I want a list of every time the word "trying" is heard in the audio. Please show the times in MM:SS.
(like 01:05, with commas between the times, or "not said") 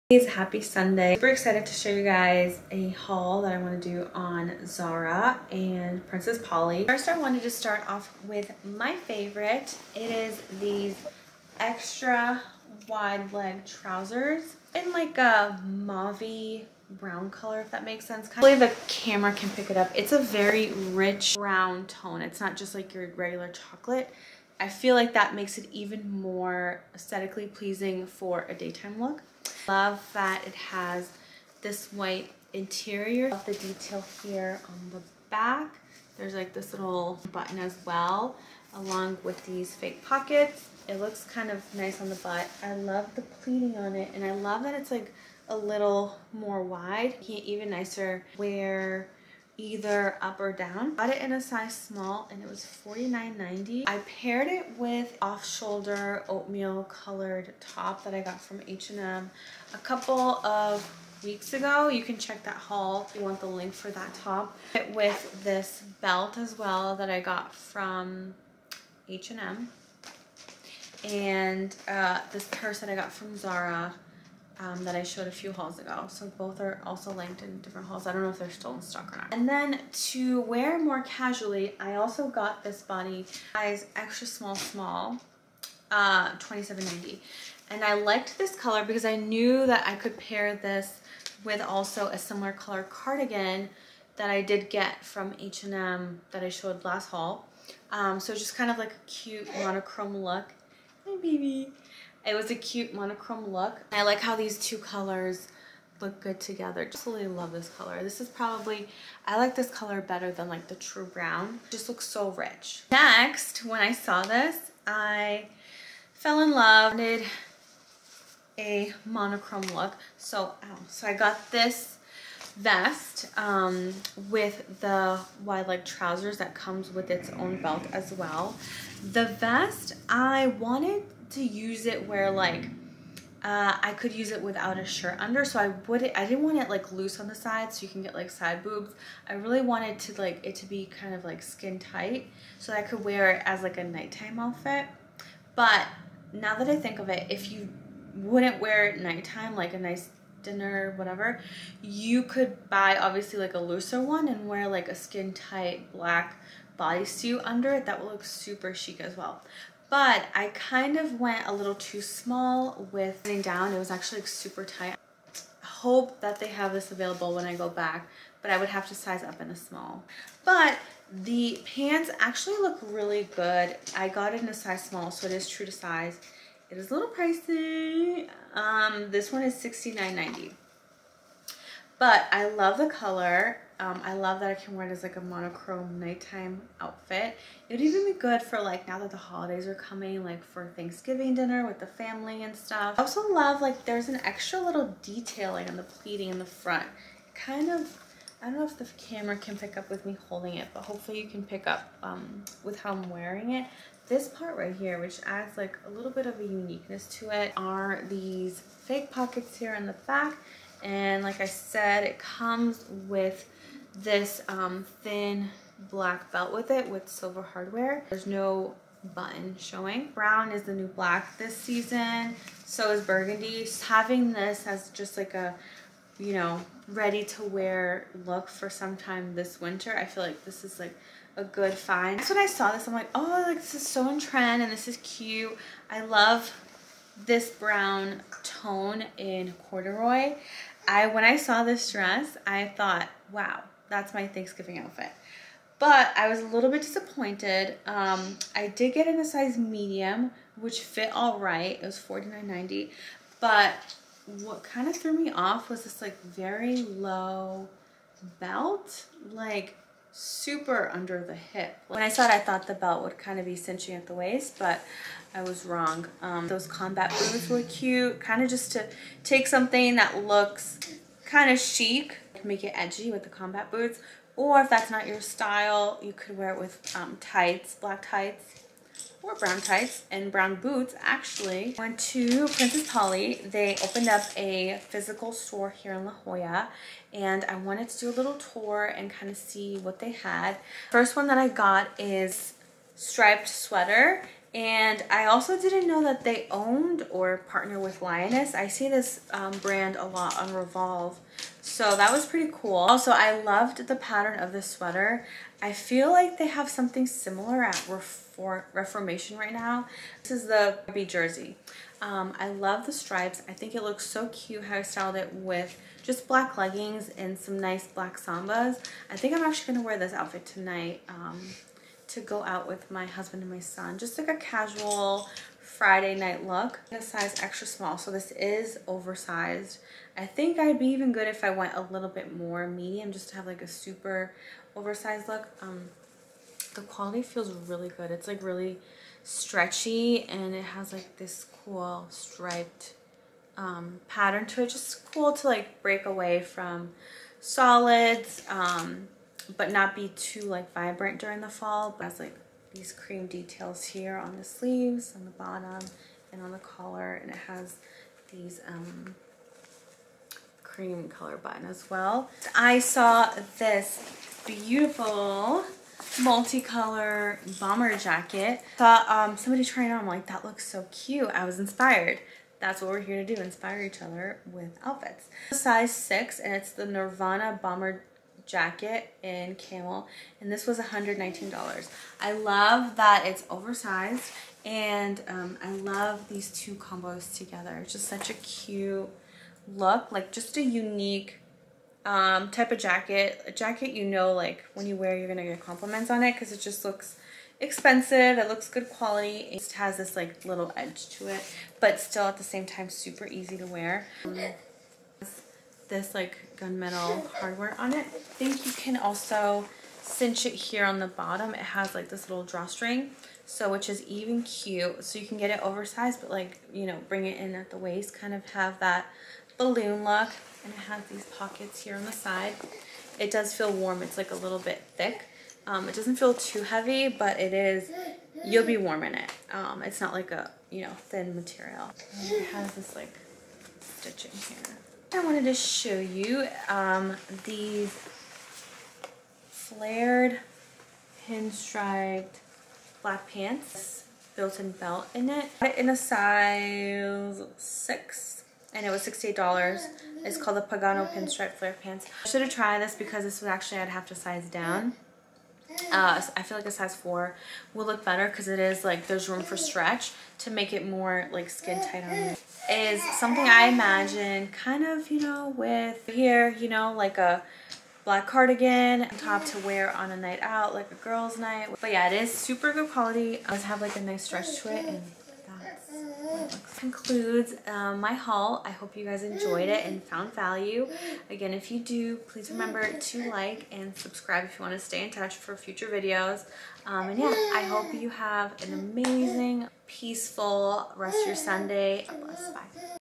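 06:09.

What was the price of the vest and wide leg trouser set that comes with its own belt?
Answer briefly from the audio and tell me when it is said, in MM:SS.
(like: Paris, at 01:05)
$69.90, at 02:59.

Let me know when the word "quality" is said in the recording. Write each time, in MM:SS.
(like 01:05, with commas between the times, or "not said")
05:36, 06:38, 07:52.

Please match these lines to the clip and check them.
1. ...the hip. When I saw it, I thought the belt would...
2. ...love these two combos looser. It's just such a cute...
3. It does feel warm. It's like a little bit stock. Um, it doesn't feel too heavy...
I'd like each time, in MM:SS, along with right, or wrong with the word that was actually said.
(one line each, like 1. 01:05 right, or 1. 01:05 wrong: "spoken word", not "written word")
1. 04:21 right
2. 06:25 wrong: "together", not "looser"
3. 07:03 wrong: "thick", not "stock".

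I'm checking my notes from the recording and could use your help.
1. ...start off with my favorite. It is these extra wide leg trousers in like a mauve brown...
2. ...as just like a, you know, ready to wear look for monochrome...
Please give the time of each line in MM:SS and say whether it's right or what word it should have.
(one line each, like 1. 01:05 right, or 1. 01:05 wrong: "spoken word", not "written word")
1. 00:07 right
2. 03:44 wrong: "sometime", not "monochrome".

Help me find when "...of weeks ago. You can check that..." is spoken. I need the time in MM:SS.
01:00.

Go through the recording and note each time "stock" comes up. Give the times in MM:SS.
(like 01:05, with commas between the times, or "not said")
01:18.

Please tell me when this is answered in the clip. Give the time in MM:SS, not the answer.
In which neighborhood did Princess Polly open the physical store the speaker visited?
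04:46.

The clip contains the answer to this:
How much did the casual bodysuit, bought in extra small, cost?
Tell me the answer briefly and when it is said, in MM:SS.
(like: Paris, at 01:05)
$27.90, at 01:26.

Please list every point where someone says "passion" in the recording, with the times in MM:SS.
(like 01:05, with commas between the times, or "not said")
not said.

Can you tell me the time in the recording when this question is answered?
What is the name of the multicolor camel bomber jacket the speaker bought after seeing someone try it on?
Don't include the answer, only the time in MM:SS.
06:16.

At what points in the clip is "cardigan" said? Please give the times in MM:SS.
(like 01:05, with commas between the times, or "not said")
01:32, 07:48.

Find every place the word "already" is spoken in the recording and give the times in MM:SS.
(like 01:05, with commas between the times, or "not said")
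not said.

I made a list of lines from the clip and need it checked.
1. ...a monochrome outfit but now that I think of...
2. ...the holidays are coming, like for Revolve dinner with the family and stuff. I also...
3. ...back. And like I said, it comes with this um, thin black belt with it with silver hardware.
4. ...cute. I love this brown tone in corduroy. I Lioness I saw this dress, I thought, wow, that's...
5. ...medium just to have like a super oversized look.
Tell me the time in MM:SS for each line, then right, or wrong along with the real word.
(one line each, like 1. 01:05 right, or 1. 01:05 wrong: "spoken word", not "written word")
1. 02:23 wrong: "nighttime", not "monochrome"
2. 03:09 wrong: "Thanksgiving", not "Revolve"
3. 03:30 right
4. 03:54 wrong: "When", not "Lioness"
5. 05:32 right.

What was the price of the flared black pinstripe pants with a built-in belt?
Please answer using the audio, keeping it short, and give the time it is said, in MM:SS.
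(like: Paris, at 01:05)
$68, at 07:29.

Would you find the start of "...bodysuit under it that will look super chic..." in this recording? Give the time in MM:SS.
02:36.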